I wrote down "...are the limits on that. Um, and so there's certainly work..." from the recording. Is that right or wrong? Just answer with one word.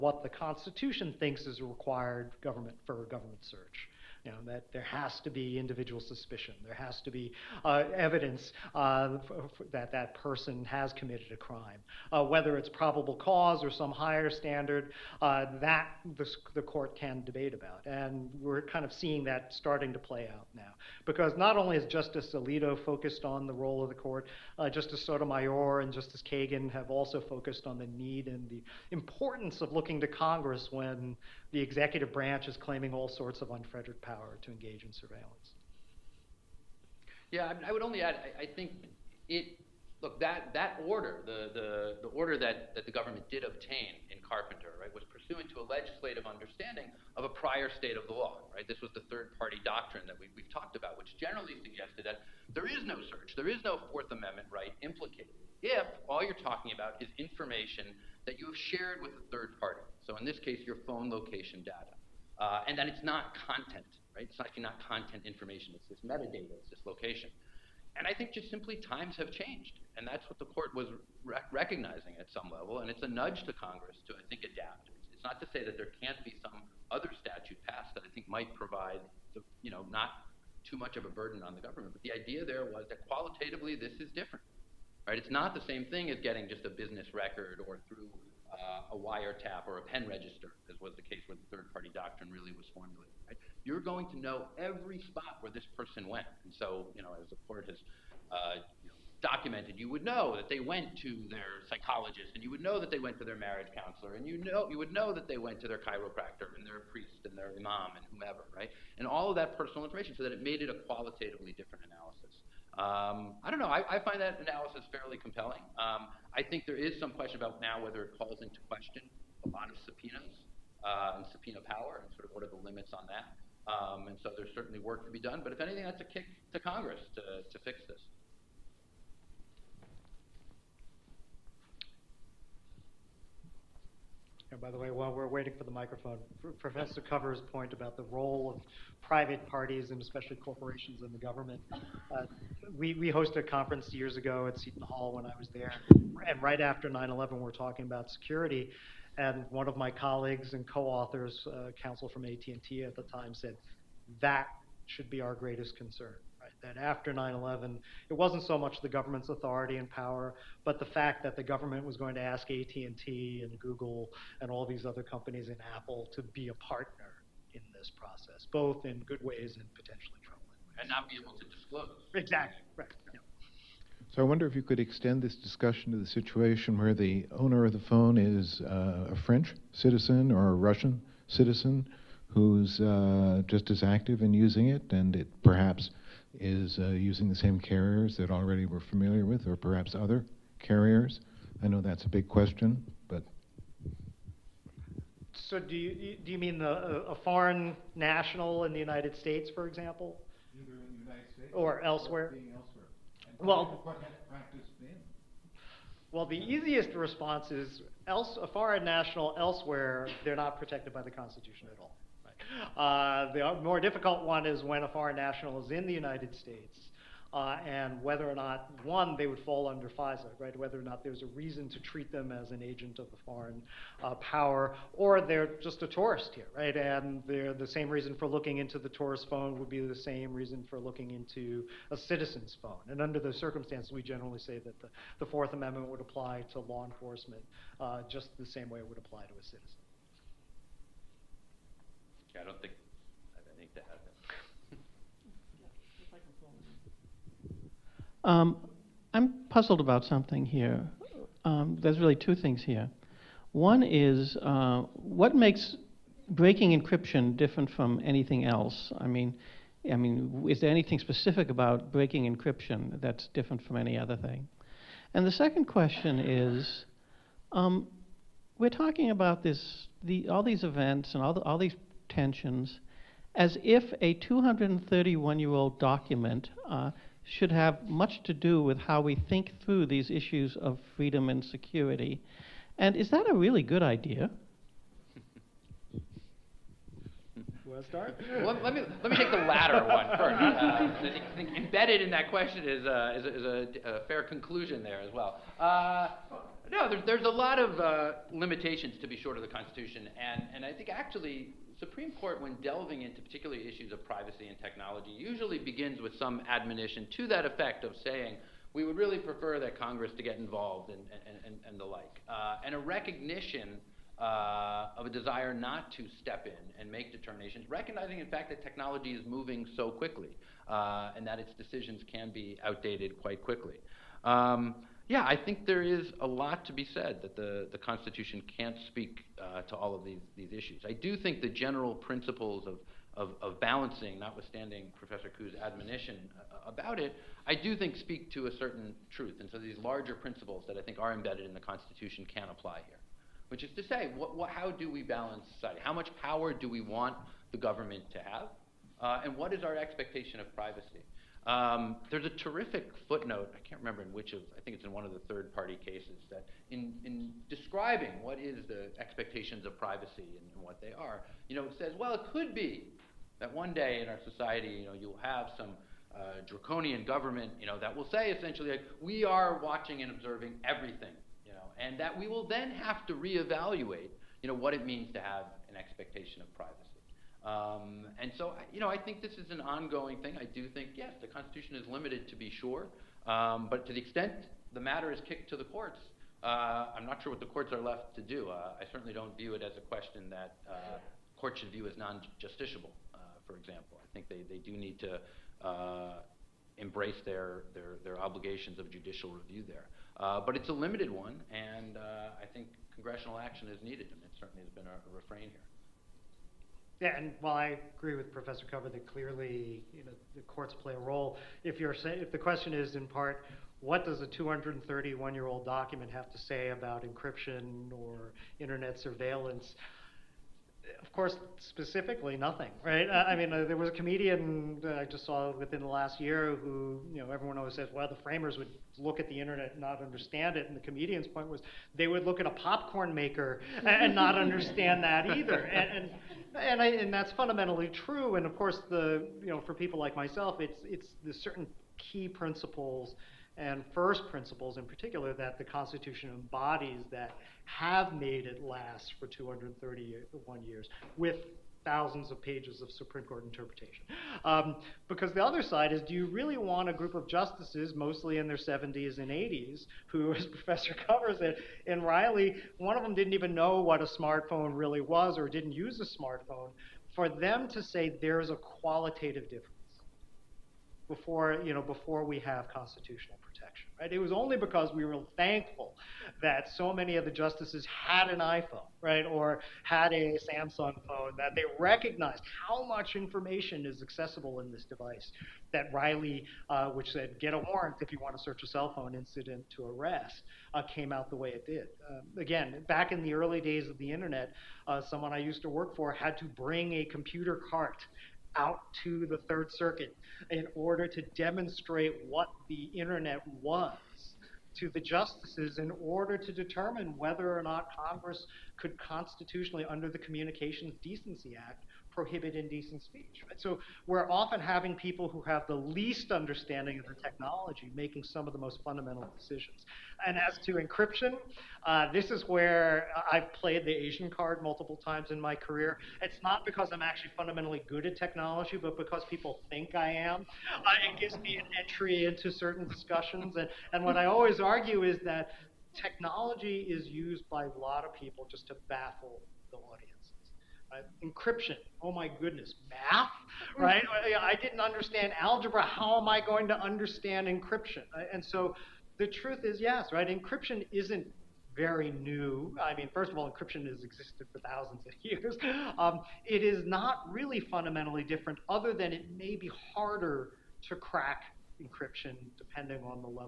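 right.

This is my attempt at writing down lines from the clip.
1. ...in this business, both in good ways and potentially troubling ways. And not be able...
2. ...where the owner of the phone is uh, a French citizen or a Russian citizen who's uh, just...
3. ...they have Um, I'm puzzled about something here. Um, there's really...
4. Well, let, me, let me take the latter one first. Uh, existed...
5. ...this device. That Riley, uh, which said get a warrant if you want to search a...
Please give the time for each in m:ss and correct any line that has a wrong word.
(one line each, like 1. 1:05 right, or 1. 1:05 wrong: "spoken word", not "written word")
1. 2:47 wrong: "process", not "business"
2. 2:56 right
3. 4:03 right
4. 4:48 wrong: "embedded", not "existed"
5. 8:04 right.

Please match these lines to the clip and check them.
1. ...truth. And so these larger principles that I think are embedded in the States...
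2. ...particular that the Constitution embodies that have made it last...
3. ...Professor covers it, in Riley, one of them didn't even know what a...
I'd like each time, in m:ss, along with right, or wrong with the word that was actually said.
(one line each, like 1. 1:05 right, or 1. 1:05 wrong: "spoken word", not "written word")
1. 5:39 wrong: "Constitution", not "States"
2. 7:24 right
3. 7:40 right.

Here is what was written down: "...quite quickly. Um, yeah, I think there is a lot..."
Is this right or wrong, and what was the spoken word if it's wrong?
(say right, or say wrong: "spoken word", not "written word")
right.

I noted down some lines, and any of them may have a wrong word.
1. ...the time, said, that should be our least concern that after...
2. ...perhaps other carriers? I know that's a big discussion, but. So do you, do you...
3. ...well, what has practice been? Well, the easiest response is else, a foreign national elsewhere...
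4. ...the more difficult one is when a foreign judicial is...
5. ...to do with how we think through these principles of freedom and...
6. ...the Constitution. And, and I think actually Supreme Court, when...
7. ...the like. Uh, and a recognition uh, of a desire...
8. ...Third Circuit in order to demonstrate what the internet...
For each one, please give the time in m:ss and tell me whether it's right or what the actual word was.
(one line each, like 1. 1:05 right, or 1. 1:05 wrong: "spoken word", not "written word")
1. 2:32 wrong: "greatest", not "least"
2. 3:09 wrong: "question", not "discussion"
3. 3:23 right
4. 3:33 wrong: "national", not "judicial"
5. 4:38 wrong: "issues", not "principles"
6. 4:59 right
7. 5:11 right
8. 8:19 right.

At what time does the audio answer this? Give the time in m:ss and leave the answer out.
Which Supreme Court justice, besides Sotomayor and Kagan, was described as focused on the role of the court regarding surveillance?
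0:21.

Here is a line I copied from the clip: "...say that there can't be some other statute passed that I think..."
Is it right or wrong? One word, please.
right.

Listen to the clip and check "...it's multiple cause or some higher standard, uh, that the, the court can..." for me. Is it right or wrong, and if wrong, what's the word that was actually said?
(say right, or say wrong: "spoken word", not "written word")
wrong: "probable", not "multiple".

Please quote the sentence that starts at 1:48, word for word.
And all of that personal information, so that it made it a qualitatively different analysis.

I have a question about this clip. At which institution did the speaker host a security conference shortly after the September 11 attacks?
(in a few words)
Seton Hall.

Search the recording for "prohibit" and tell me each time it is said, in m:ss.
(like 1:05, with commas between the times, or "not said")
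8:32.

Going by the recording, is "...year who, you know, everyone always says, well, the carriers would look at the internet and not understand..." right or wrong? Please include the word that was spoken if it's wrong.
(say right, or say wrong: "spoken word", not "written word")
wrong: "framers", not "carriers".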